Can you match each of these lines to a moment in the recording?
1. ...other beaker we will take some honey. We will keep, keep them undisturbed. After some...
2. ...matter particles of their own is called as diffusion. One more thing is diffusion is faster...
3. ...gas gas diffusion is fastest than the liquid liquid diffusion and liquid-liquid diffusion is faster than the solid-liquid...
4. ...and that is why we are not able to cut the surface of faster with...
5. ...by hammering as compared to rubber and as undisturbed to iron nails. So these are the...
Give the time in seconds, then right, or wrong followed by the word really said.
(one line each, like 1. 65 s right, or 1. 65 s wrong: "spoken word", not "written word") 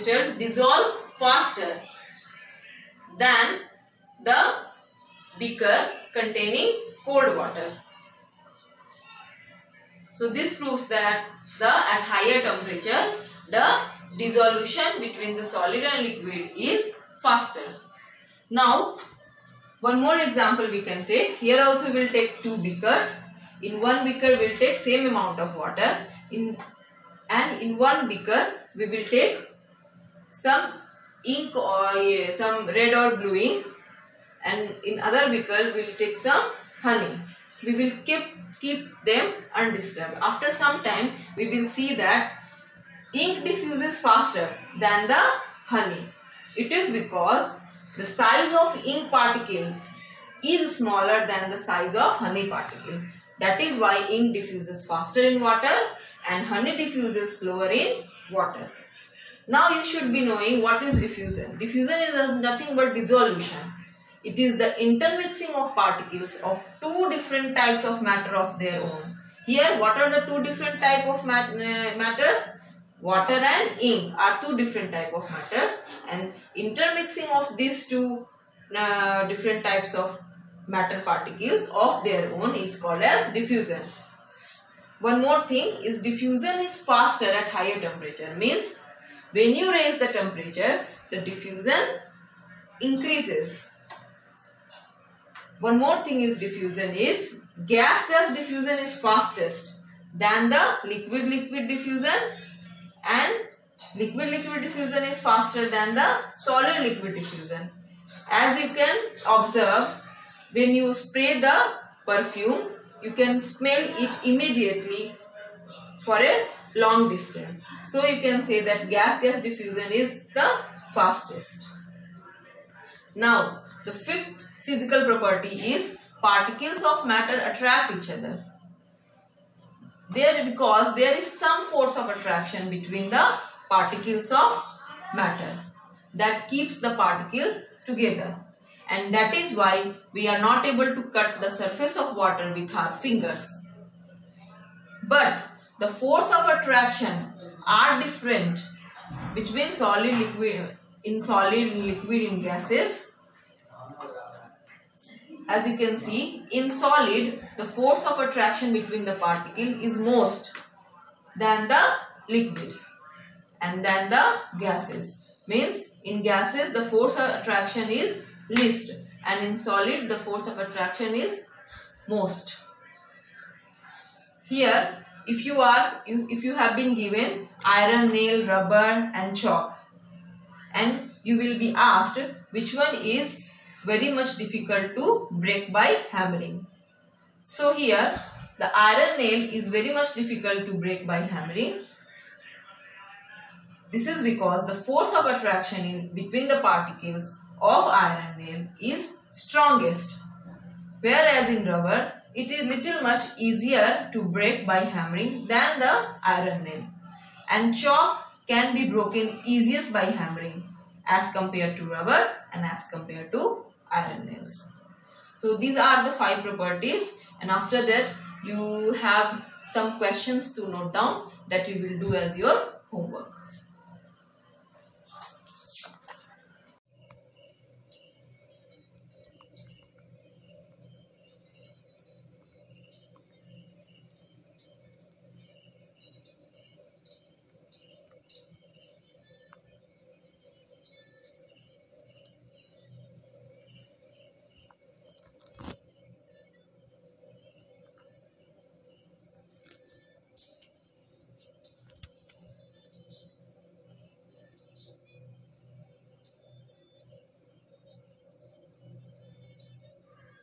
1. 34 s right
2. 80 s right
3. 97 s right
4. 138 s wrong: "water", not "faster"
5. 209 s wrong: "compared", not "undisturbed".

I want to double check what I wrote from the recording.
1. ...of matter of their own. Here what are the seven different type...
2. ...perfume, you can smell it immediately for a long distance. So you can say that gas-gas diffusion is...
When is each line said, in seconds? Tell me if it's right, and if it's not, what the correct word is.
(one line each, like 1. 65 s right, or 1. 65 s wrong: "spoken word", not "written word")
1. 67 s wrong: "two", not "seven"
2. 112 s right.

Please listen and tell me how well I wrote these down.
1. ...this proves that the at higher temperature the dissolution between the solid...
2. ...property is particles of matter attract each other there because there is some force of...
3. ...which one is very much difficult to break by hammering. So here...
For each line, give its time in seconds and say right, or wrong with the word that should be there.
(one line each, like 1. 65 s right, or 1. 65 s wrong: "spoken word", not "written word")
1. 10 s right
2. 125 s right
3. 182 s right.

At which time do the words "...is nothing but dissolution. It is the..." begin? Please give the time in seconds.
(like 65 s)
62 s.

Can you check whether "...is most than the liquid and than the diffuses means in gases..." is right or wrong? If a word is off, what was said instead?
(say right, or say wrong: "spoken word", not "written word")
wrong: "gases", not "diffuses".